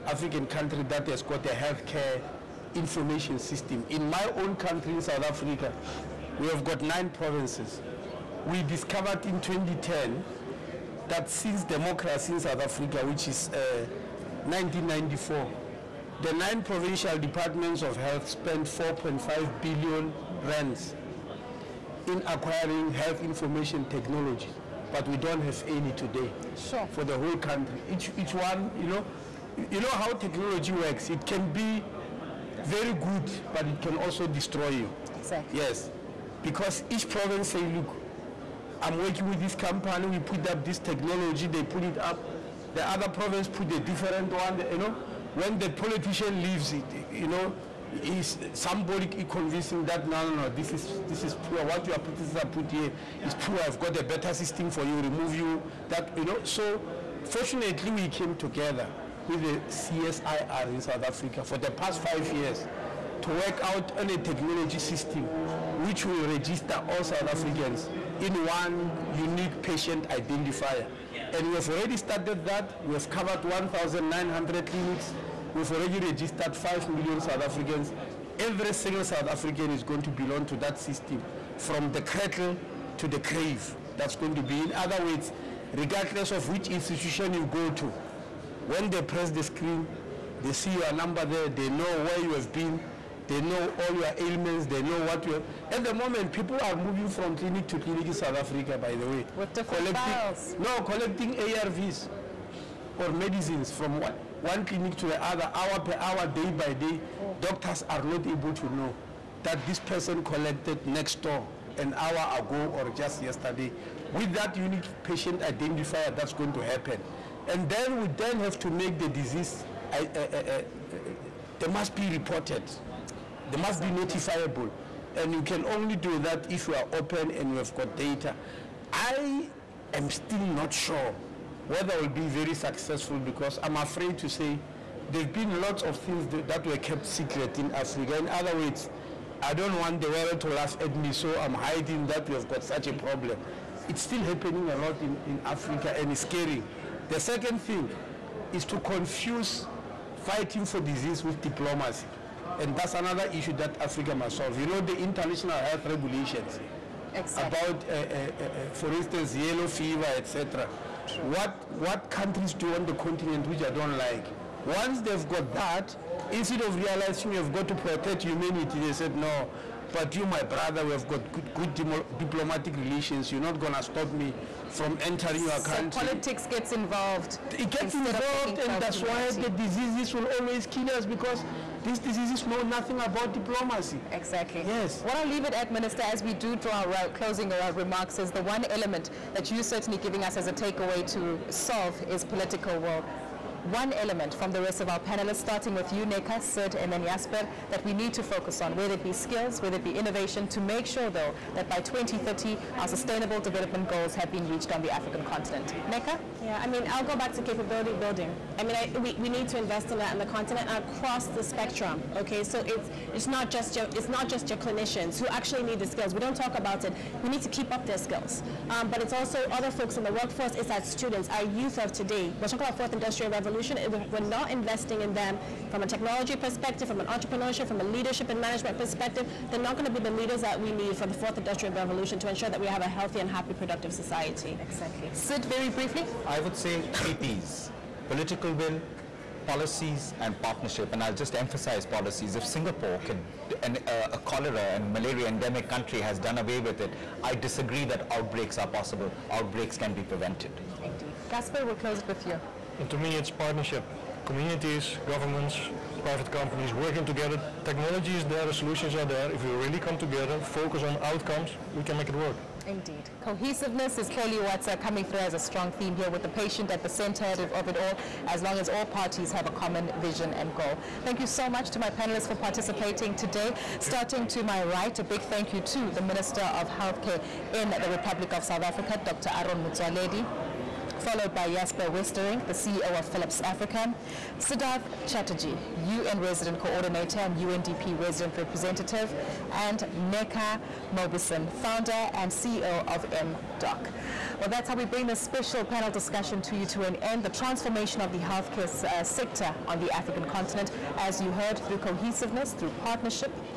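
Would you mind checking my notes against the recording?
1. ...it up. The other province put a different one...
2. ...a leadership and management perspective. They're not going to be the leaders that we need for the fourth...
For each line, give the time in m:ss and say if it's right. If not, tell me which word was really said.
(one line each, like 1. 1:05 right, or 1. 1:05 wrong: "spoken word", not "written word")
1. 0:41 right
2. 3:47 right.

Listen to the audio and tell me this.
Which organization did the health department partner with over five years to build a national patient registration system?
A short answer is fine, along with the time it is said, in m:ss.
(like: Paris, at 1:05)
CSIR, at 0:59.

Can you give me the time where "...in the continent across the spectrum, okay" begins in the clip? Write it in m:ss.
3:30.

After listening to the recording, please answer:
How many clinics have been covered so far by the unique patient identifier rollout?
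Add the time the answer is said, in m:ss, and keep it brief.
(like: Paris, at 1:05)
1,900, at 1:13.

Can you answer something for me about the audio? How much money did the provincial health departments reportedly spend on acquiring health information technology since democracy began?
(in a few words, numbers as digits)
4.5 billion rands.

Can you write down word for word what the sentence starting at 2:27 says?
The second thing is to confuse fighting for disease with diplomacy.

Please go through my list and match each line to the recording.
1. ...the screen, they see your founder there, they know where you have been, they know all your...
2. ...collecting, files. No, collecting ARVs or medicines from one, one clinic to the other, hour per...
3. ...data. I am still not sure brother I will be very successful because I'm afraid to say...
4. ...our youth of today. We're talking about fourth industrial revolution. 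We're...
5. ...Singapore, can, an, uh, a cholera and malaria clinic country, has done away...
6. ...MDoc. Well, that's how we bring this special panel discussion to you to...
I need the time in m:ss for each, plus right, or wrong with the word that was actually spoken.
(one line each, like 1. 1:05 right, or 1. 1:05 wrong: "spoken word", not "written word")
1. 1:29 wrong: "number", not "founder"
2. 1:39 right
3. 2:07 wrong: "whether", not "brother"
4. 3:41 right
5. 4:02 wrong: "endemic", not "clinic"
6. 4:53 right.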